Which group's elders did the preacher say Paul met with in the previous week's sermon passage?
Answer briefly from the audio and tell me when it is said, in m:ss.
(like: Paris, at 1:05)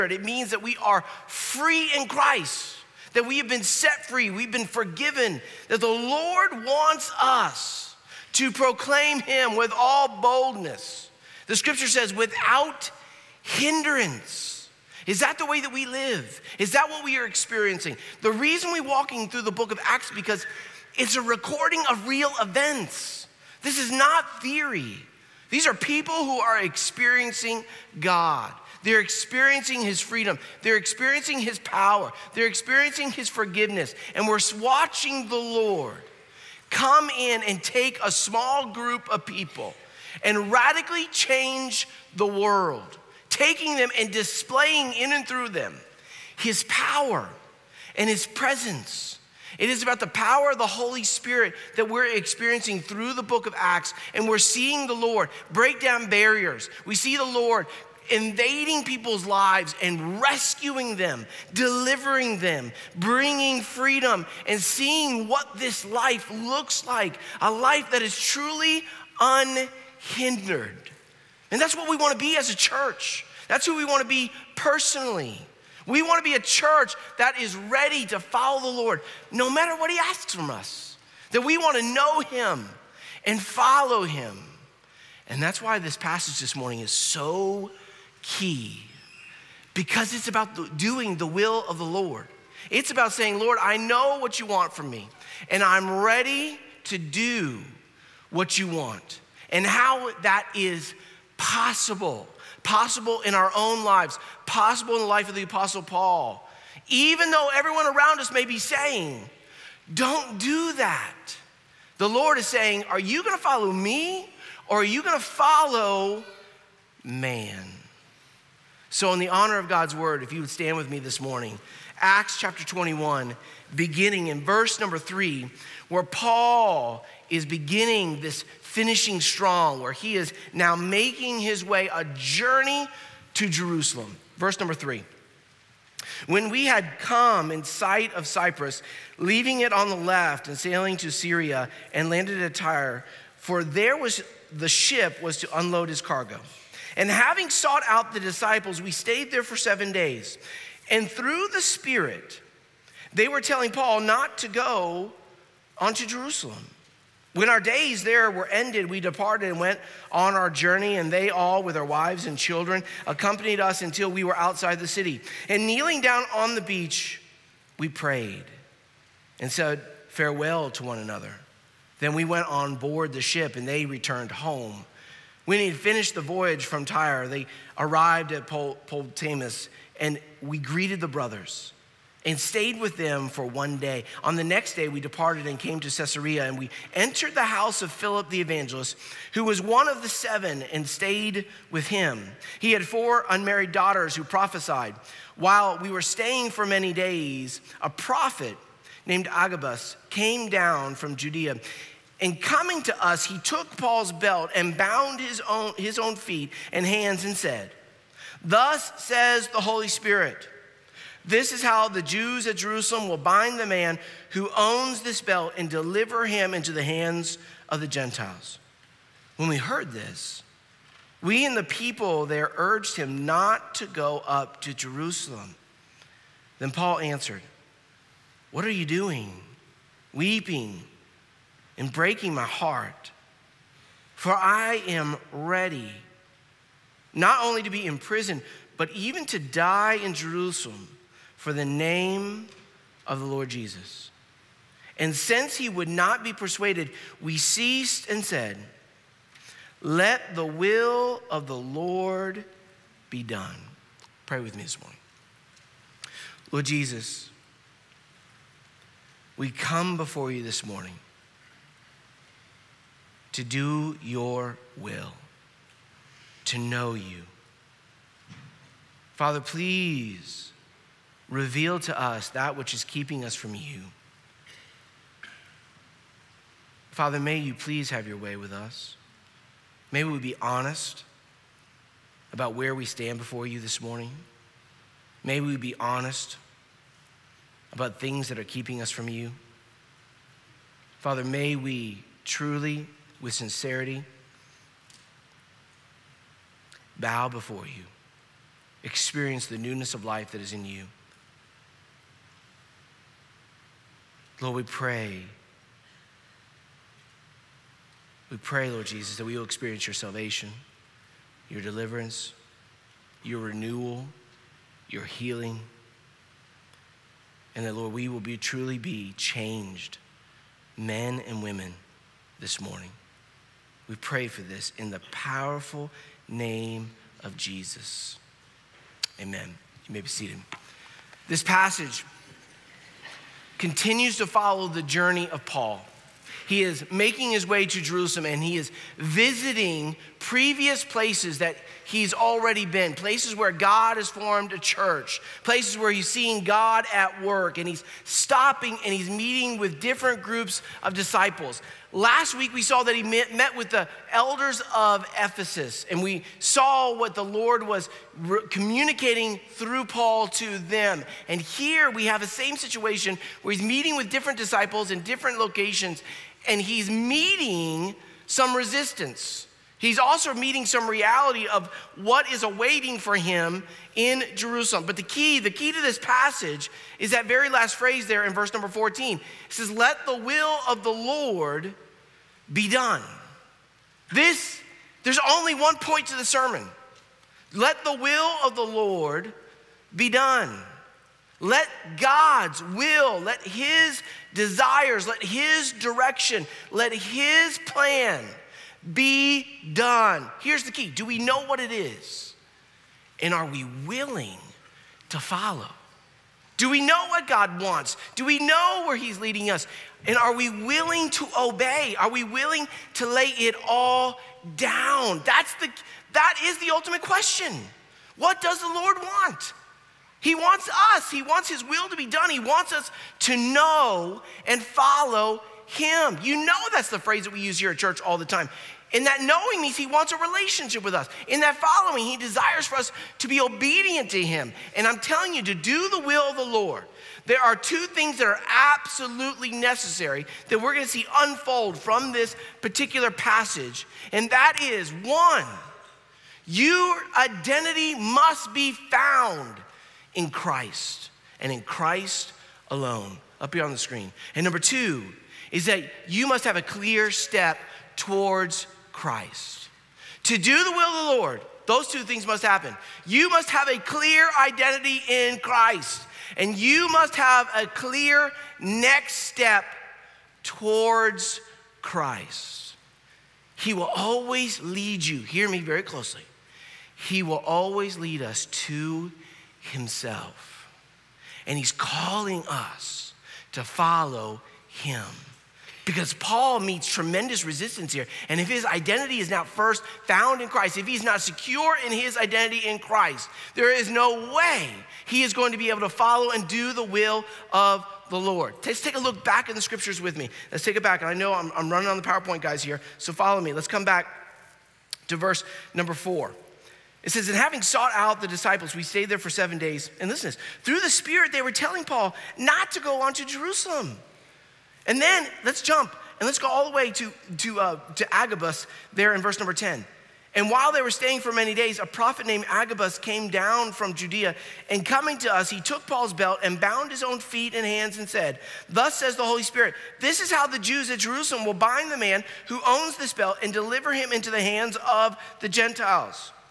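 Ephesus, at 5:54.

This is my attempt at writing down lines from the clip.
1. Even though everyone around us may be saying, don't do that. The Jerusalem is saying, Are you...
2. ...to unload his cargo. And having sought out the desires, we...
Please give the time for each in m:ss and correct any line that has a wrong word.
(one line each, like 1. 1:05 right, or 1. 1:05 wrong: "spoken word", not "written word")
1. 1:46 wrong: "Lord", not "Jerusalem"
2. 2:25 wrong: "disciples", not "desires".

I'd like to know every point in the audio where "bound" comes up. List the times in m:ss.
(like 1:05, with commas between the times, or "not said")
3:24, 8:46.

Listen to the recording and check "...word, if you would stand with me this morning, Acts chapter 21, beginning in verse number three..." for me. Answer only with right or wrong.
right.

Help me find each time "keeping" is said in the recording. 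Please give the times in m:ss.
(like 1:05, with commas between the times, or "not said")
4:32, 4:48.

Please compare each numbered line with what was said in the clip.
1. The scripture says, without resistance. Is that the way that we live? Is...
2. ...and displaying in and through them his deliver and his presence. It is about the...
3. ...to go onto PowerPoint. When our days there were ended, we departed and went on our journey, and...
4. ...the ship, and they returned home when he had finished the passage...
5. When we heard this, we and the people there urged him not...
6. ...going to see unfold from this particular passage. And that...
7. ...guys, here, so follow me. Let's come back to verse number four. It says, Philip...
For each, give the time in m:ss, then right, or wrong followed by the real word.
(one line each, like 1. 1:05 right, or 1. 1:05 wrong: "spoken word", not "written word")
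1. 0:11 wrong: "hindrance", not "resistance"
2. 0:43 wrong: "power", not "deliver"
3. 2:34 wrong: "Jerusalem", not "PowerPoint"
4. 2:53 wrong: "voyage", not "passage"
5. 3:39 right
6. 7:20 right
7. 8:22 wrong: "And", not "Philip".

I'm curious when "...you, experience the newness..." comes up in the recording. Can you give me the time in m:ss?
4:57.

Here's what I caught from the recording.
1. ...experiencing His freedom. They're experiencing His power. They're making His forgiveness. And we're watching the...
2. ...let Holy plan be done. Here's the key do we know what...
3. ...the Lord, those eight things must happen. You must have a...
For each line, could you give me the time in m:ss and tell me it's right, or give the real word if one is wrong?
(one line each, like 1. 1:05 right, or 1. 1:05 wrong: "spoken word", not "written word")
1. 0:28 wrong: "experiencing", not "making"
2. 6:36 wrong: "His", not "Holy"
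3. 7:41 wrong: "two", not "eight".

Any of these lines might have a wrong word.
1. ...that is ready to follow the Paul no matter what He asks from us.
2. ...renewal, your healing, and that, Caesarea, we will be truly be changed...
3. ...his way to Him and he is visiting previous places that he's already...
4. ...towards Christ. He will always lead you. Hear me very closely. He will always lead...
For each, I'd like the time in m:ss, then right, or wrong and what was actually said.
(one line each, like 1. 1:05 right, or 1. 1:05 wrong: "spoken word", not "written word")
1. 1:17 wrong: "Lord", not "Paul"
2. 5:13 wrong: "Lord", not "Caesarea"
3. 5:37 wrong: "Jerusalem", not "Him"
4. 7:50 right.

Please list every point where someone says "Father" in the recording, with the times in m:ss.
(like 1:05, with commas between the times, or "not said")
4:29, 4:36, 4:51.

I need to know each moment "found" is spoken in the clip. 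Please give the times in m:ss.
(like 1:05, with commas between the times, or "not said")
7:28, 8:10.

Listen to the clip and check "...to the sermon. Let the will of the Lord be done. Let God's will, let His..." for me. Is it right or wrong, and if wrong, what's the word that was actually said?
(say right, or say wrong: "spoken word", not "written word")
right.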